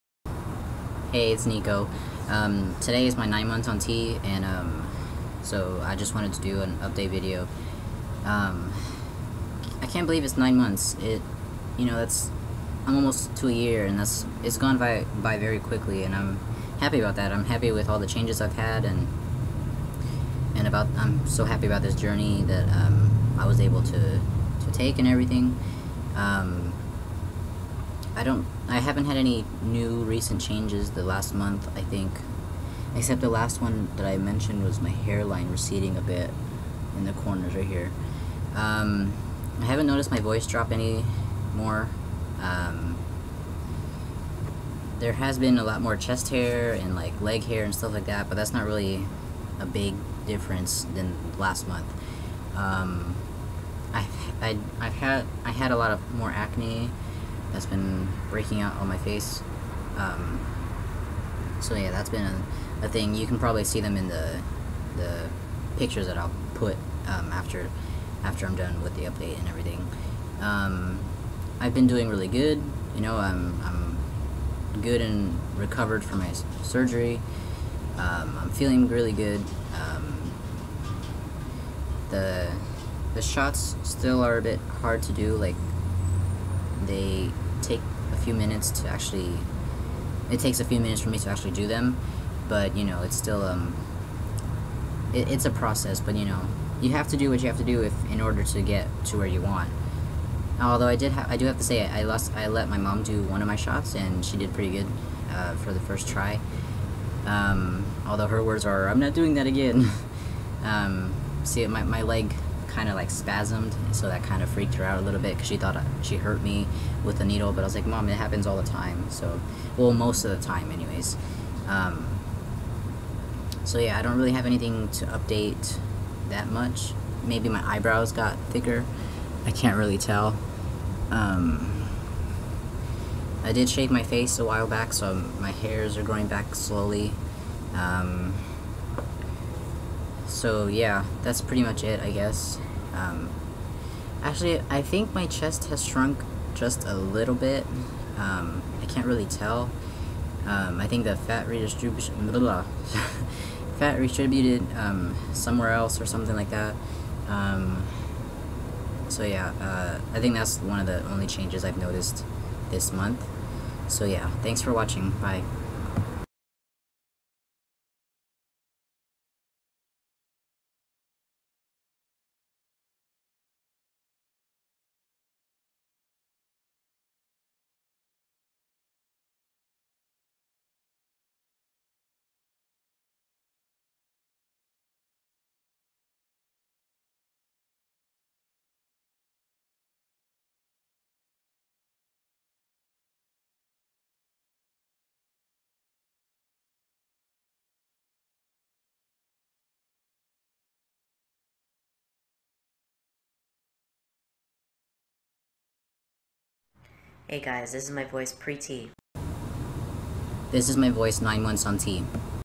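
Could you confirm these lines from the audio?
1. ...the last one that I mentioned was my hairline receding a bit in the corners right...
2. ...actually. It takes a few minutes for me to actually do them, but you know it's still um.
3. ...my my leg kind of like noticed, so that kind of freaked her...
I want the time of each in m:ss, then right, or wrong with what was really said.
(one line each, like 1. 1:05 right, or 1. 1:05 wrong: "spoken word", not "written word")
1. 0:33 right
2. 1:28 right
3. 1:51 wrong: "spasmed", not "noticed".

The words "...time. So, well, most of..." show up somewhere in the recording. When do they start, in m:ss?
1:58.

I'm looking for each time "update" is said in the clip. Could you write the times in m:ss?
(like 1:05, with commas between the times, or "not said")
0:06, 1:09, 2:05.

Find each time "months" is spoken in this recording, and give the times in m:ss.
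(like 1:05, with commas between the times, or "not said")
0:03, 0:10, 0:31, 0:51, 2:42, 3:31.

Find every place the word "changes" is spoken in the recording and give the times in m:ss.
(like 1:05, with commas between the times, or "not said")
0:18, 0:30, 2:41.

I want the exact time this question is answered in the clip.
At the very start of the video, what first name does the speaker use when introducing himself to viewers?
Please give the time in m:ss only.
0:01.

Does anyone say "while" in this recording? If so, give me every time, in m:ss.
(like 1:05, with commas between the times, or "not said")
2:14.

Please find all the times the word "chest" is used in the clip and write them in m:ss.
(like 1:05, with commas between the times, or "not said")
0:45, 2:25.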